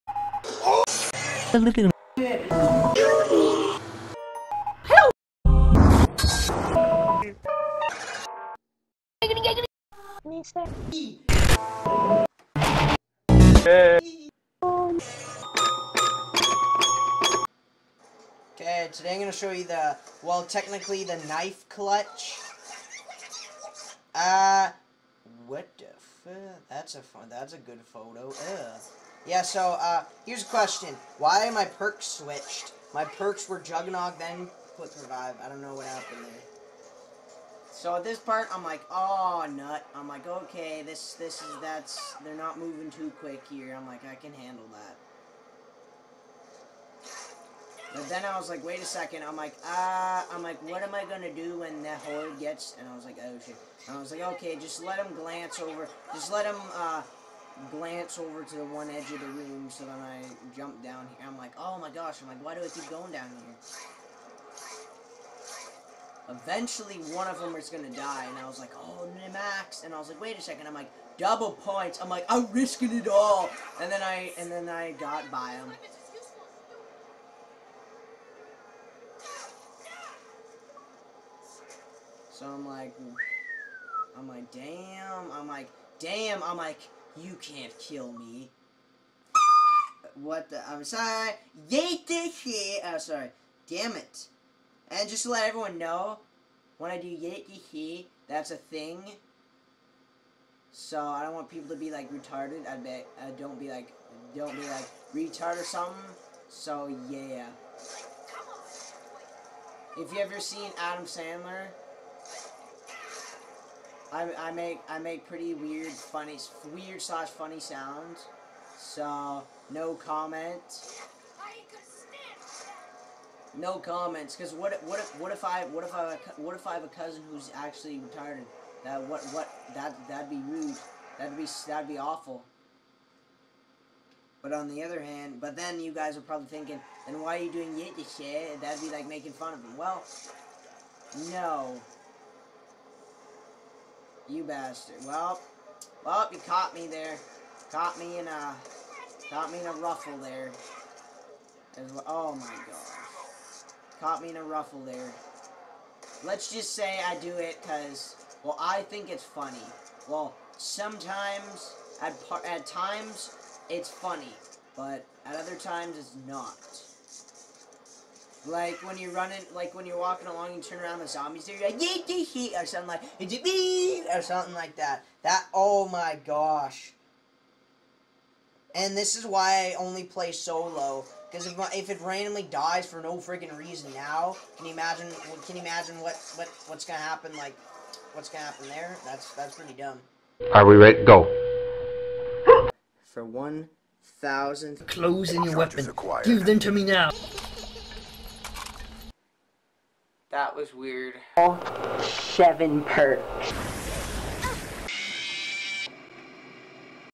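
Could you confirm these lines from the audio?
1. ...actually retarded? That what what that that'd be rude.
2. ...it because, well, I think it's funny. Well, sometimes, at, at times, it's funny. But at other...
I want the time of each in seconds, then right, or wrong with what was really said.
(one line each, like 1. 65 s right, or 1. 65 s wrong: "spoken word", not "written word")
1. 127 s right
2. 157 s right.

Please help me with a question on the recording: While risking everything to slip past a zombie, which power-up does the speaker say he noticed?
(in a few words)
Double points.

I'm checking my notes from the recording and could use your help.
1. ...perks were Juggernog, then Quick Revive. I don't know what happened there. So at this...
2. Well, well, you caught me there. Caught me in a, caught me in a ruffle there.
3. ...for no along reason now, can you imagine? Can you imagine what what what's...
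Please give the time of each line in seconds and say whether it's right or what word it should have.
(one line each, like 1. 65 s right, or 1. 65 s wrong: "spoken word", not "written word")
1. 33 s right
2. 145 s right
3. 182 s wrong: "freaking", not "along".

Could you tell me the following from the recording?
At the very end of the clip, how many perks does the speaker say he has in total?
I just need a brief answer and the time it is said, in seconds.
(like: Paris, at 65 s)
7, at 202 s.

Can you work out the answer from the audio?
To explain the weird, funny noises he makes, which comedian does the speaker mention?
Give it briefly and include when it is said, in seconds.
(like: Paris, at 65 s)
Adam Sandler, at 110 s.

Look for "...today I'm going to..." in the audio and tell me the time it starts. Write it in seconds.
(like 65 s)
18 s.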